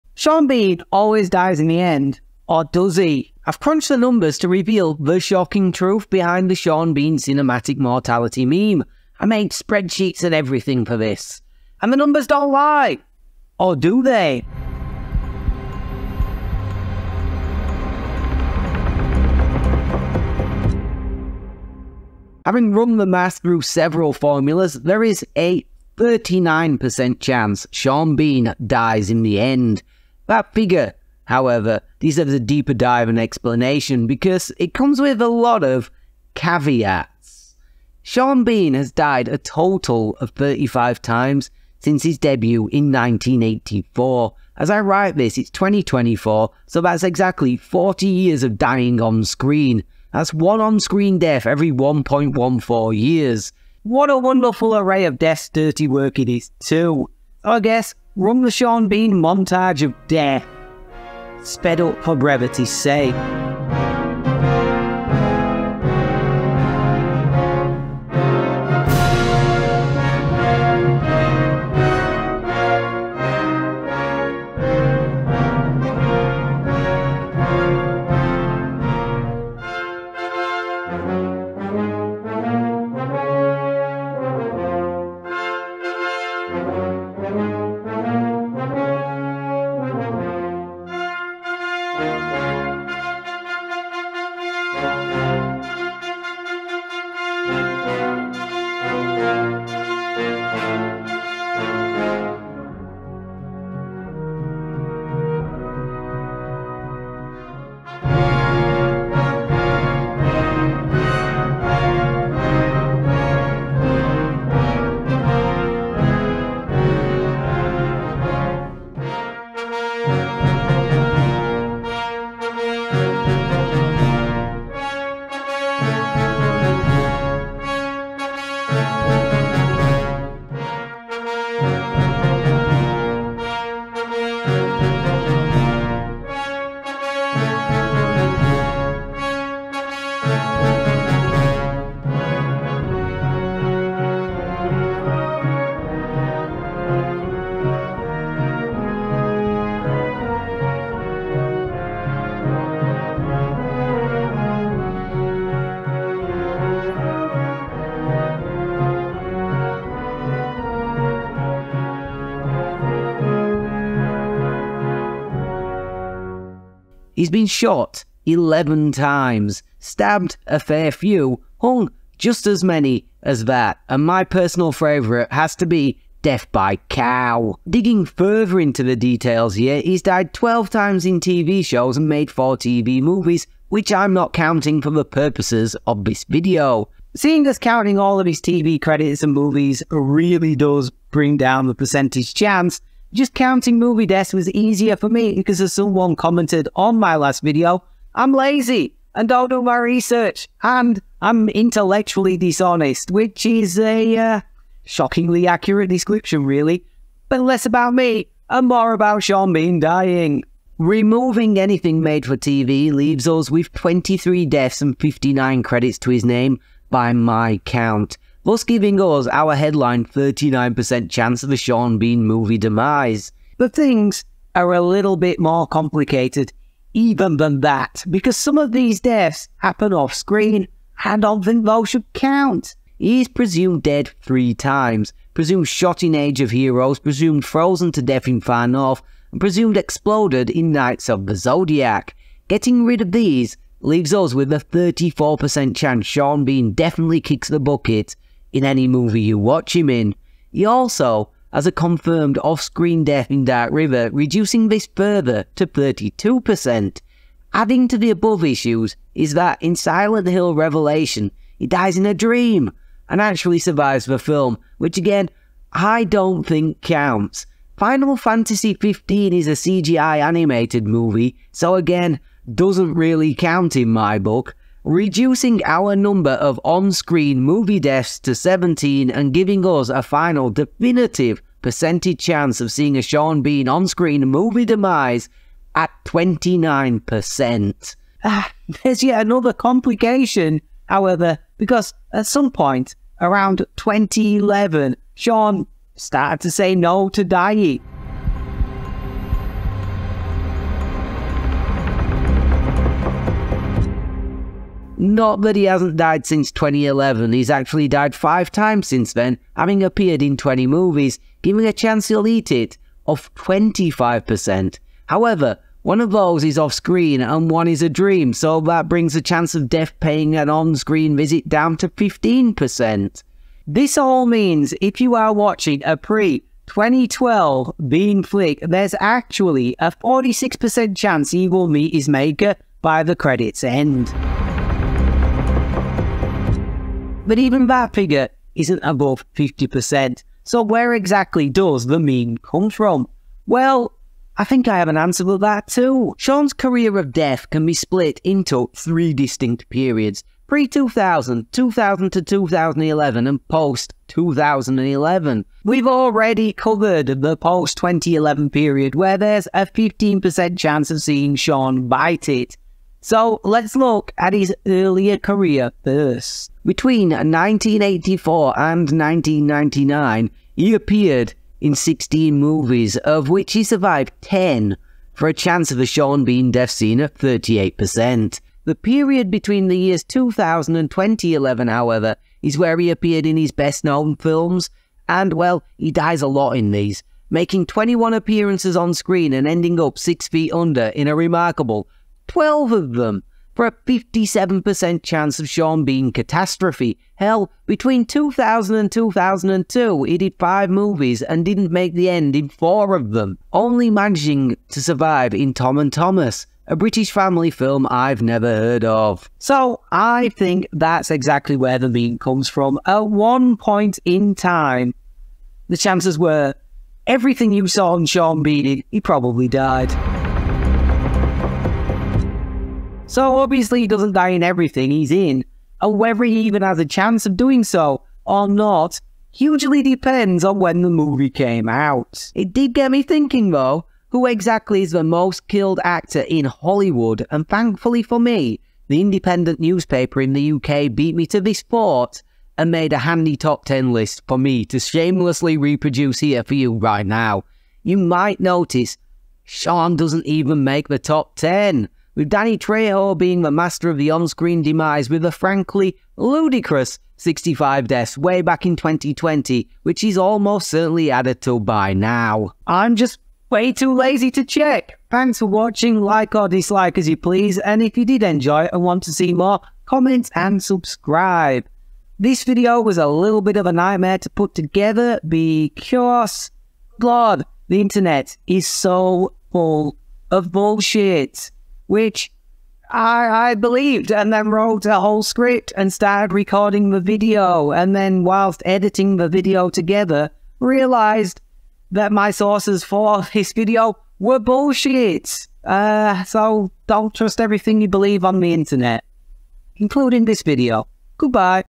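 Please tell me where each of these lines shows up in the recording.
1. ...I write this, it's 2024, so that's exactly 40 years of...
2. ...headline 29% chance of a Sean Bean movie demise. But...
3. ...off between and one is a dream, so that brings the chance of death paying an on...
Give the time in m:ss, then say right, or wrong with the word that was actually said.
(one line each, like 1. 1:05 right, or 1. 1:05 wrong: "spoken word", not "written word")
1. 0:44 right
2. 3:39 wrong: "39", not "29"
3. 5:16 wrong: "screen", not "between".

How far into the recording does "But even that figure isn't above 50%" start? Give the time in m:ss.
5:37.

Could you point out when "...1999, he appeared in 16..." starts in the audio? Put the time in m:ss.
6:08.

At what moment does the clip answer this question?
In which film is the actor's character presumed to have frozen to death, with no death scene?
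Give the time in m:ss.
3:58.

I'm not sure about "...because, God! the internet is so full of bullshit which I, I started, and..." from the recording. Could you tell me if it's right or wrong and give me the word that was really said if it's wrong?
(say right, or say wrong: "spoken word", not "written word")
wrong: "believed", not "started".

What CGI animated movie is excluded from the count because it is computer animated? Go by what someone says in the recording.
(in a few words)
Final Fantasy XV.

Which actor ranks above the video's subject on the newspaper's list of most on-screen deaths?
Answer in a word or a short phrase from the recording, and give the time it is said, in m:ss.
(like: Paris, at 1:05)
Danny Trejo, at 7:32.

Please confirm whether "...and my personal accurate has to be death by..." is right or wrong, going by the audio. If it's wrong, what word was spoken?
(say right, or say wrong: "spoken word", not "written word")
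wrong: "favourite", not "accurate".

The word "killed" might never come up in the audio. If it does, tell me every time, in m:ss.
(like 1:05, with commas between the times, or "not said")
7:15.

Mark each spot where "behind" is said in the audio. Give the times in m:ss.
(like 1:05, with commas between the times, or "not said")
0:06.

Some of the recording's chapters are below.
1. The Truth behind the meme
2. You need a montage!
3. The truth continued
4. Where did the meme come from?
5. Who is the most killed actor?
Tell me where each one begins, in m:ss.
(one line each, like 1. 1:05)
1. 0:14
2. 1:00
3. 2:46
4. 5:34
5. 7:00.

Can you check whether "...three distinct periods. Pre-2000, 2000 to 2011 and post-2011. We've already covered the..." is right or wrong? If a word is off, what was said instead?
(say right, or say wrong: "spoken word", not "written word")
right.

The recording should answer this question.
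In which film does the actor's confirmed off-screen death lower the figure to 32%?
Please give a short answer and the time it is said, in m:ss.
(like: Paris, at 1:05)
Dark River, at 4:13.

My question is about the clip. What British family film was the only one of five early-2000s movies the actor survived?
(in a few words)
Tom and Thomas.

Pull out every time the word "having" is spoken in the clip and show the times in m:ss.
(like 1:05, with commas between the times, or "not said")
0:22, 5:09.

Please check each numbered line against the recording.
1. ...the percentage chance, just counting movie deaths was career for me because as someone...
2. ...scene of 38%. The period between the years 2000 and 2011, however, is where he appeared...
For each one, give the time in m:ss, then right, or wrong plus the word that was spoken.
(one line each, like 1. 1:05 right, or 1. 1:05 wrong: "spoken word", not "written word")
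1. 3:11 wrong: "easier", not "career"
2. 6:16 right.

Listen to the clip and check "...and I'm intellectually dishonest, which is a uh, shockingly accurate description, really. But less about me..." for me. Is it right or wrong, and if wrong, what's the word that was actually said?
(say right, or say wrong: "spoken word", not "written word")
right.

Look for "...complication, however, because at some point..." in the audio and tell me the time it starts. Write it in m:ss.
4:49.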